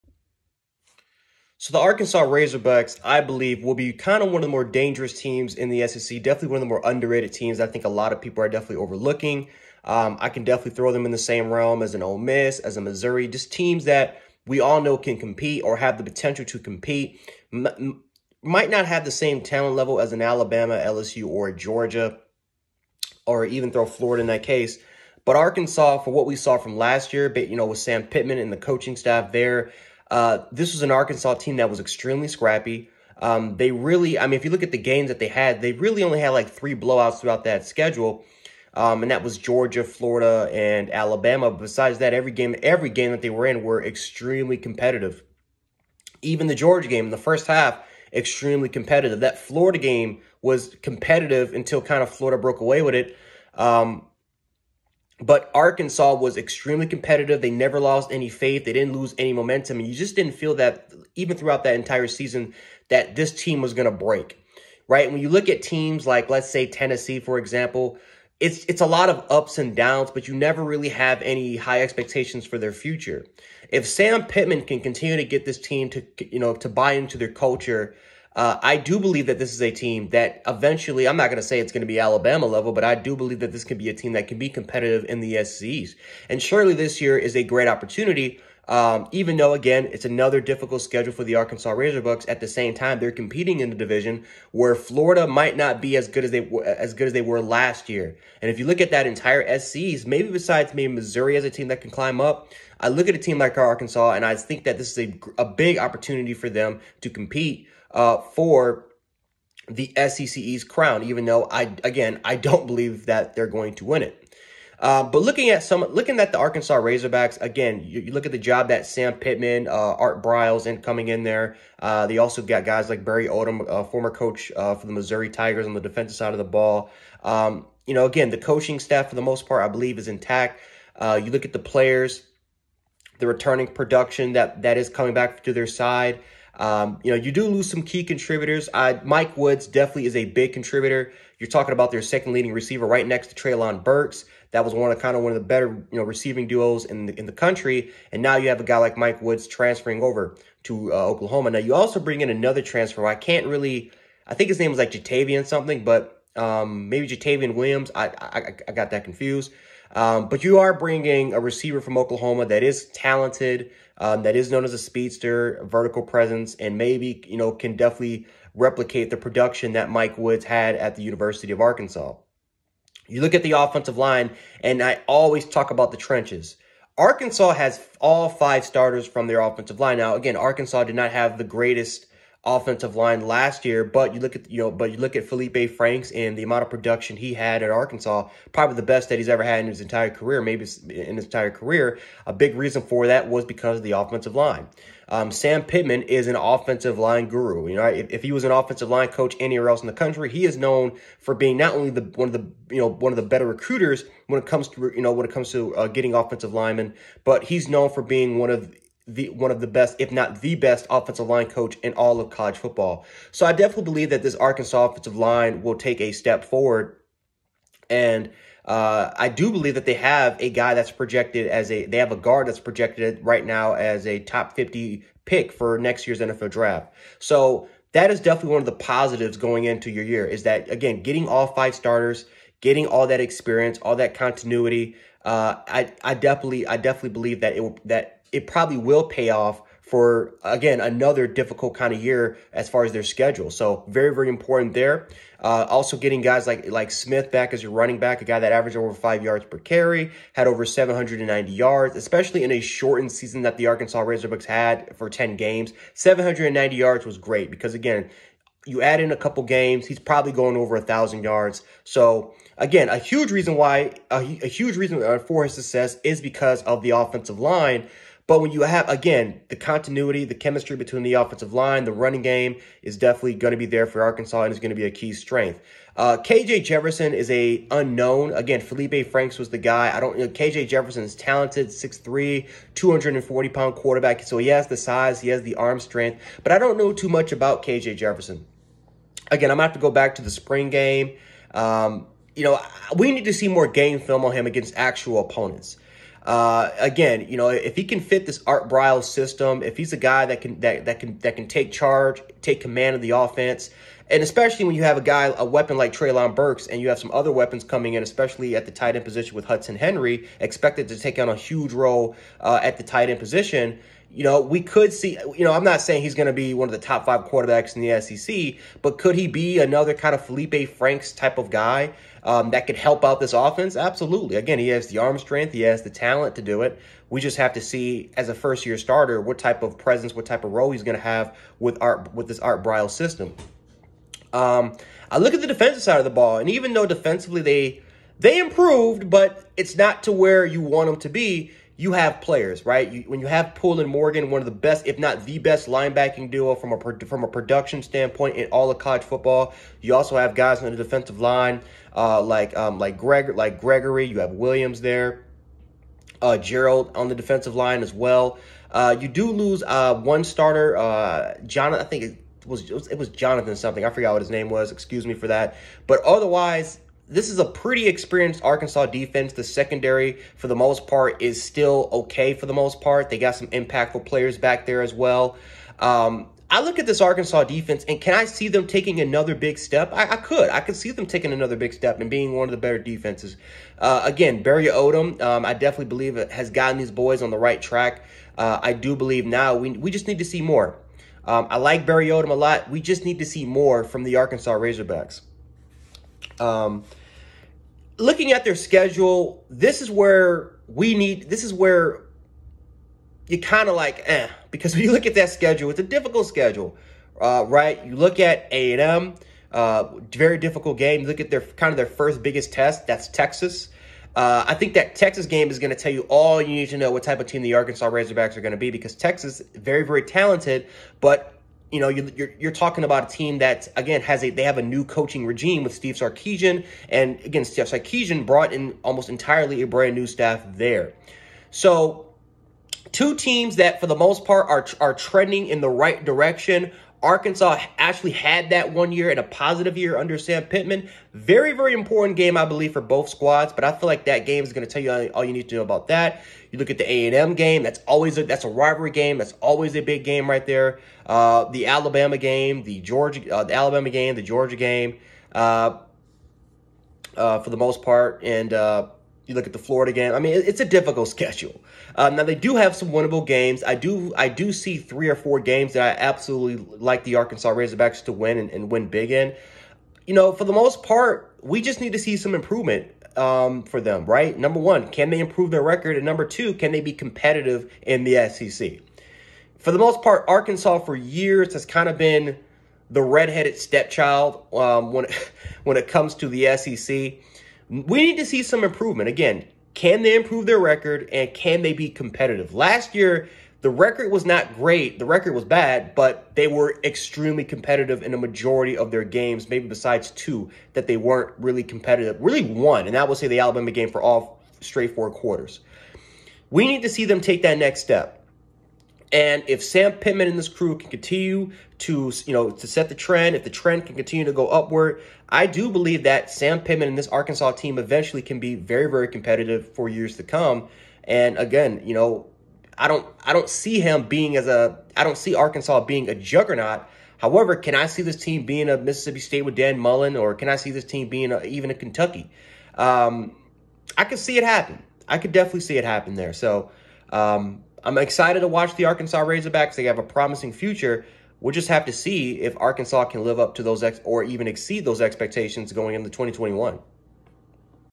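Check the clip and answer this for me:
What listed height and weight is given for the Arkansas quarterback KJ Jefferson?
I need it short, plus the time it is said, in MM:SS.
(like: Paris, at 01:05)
6'3, 240 pounds, at 04:41.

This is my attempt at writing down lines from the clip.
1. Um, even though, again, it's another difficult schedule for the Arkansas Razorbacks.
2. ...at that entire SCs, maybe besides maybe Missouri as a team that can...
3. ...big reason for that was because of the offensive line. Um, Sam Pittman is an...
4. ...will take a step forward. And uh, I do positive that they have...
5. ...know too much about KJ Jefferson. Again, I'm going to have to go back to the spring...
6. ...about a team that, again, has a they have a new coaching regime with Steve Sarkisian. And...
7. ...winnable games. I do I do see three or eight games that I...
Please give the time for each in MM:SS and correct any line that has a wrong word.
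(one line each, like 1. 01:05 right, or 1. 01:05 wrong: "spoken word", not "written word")
1. 01:28 right
2. 01:38 right
3. 03:12 right
4. 03:35 wrong: "believe", not "positive"
5. 04:46 right
6. 07:02 right
7. 07:42 wrong: "four", not "eight".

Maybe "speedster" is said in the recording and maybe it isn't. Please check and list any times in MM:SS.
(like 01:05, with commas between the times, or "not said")
02:44.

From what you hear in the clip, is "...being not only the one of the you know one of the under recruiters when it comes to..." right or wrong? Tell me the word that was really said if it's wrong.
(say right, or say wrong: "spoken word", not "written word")
wrong: "better", not "under".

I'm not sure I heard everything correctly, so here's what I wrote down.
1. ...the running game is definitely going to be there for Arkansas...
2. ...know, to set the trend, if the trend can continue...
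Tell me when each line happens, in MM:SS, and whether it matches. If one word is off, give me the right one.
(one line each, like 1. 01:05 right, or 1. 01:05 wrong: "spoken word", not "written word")
1. 04:31 right
2. 08:32 right.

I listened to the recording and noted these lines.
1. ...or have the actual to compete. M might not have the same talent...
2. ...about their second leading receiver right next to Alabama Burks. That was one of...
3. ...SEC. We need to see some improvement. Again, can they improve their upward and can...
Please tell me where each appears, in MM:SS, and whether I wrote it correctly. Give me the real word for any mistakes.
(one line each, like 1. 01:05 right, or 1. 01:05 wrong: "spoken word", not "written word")
1. 00:15 wrong: "potential", not "actual"
2. 02:21 wrong: "Treylon", not "Alabama"
3. 08:06 wrong: "record", not "upward".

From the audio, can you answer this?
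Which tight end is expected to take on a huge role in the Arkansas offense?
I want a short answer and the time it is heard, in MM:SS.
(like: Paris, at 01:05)
Hudson Henry, at 05:09.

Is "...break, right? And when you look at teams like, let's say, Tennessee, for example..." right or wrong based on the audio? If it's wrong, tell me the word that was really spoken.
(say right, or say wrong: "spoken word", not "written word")
right.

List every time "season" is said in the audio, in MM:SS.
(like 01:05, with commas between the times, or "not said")
01:02, 04:13.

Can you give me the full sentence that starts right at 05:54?
You have Williams there, uh, Gerald on the defensive line as well.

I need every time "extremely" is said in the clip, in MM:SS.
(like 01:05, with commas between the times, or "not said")
00:31, 00:43, 00:48, 00:56, 08:16.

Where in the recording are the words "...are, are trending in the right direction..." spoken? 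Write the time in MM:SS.
07:14.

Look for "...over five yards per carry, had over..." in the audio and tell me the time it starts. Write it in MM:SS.
04:08.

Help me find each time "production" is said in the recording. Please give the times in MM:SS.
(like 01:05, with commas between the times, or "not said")
02:13, 02:49, 03:06, 05:47.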